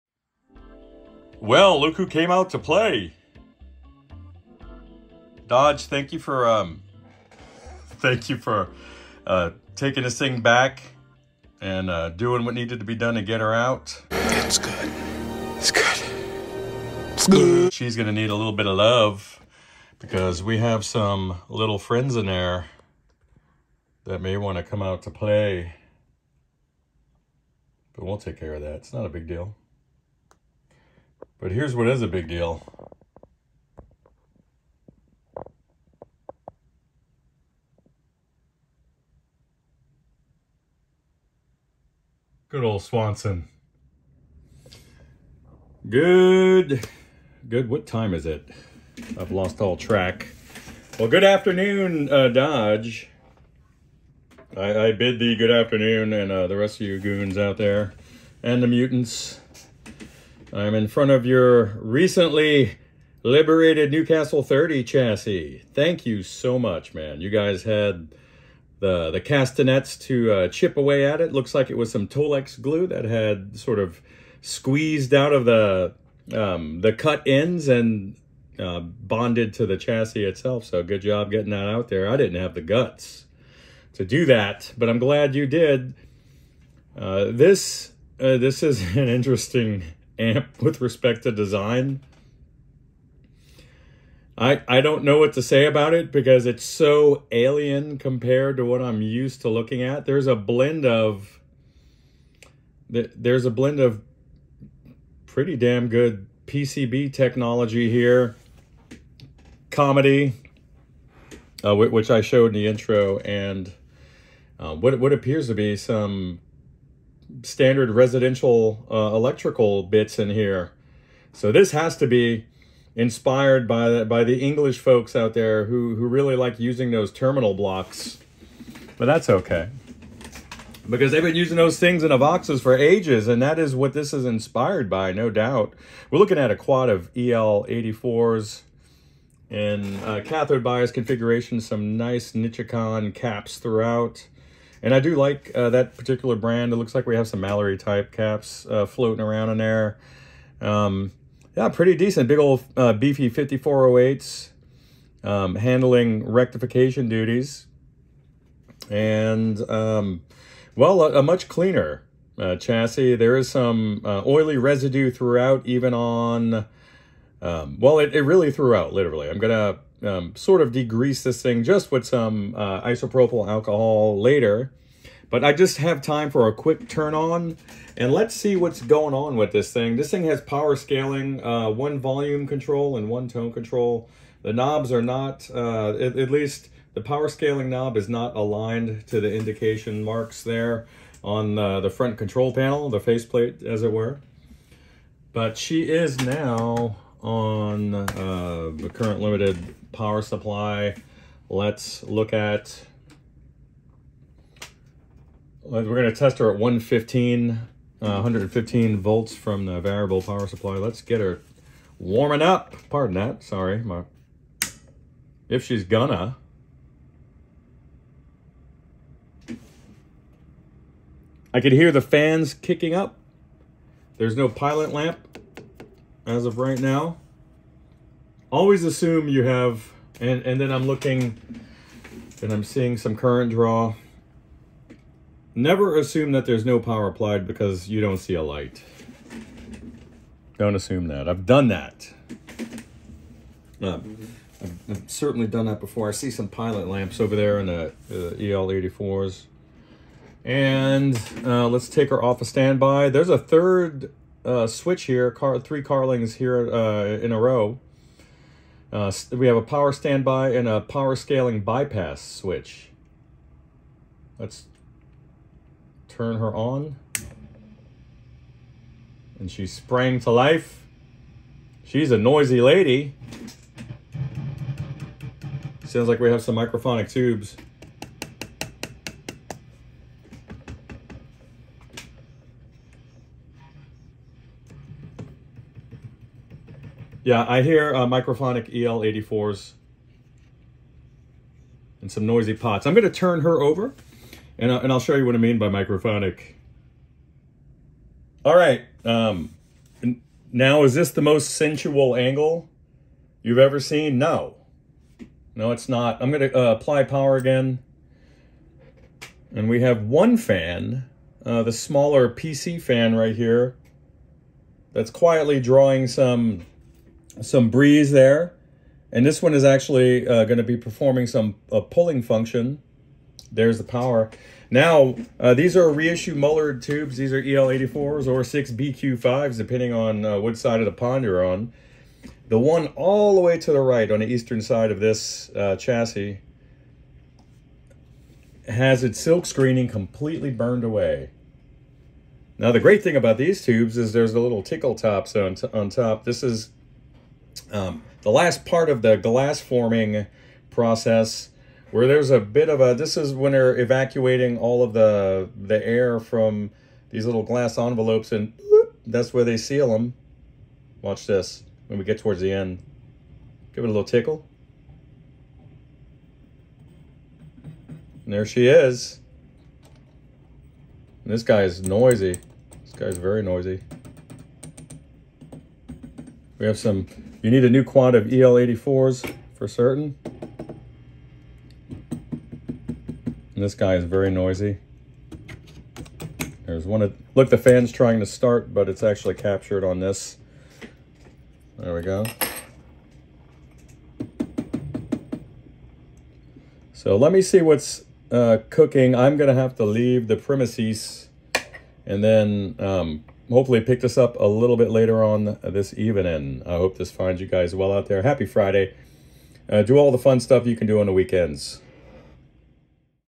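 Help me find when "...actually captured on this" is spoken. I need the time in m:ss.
6:29.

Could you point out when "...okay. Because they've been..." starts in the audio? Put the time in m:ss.
2:09.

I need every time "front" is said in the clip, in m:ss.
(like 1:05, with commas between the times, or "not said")
1:00, 3:11.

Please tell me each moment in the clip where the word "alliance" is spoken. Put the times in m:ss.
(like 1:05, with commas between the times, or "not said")
not said.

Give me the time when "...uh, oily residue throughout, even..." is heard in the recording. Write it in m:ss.
2:44.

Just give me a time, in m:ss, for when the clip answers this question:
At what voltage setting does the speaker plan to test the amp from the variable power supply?
3:27.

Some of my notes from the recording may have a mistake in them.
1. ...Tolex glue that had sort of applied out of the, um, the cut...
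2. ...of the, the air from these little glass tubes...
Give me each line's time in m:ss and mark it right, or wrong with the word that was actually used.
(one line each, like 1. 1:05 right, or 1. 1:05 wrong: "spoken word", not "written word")
1. 1:12 wrong: "squeezed", not "applied"
2. 5:54 wrong: "envelopes", not "tubes".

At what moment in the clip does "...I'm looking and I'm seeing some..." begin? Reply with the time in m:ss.
3:50.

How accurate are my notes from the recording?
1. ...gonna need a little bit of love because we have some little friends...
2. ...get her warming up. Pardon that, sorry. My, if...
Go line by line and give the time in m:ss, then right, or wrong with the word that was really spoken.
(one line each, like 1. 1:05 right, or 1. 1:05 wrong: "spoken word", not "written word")
1. 0:17 right
2. 3:31 right.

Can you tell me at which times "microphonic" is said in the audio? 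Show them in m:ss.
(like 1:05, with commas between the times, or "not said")
4:36, 4:48, 4:55.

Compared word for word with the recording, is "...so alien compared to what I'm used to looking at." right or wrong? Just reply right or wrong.
right.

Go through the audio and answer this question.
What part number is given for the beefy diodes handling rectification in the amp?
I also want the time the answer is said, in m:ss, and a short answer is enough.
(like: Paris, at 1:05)
5408, at 2:33.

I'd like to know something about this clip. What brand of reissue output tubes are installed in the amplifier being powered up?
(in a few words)
Mullard.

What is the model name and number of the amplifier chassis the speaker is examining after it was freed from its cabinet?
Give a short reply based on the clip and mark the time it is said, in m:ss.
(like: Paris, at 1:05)
Newcastle 30, at 1:03.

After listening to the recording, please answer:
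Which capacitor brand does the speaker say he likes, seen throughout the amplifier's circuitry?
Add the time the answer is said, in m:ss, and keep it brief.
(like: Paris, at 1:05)
Nichicon, at 2:22.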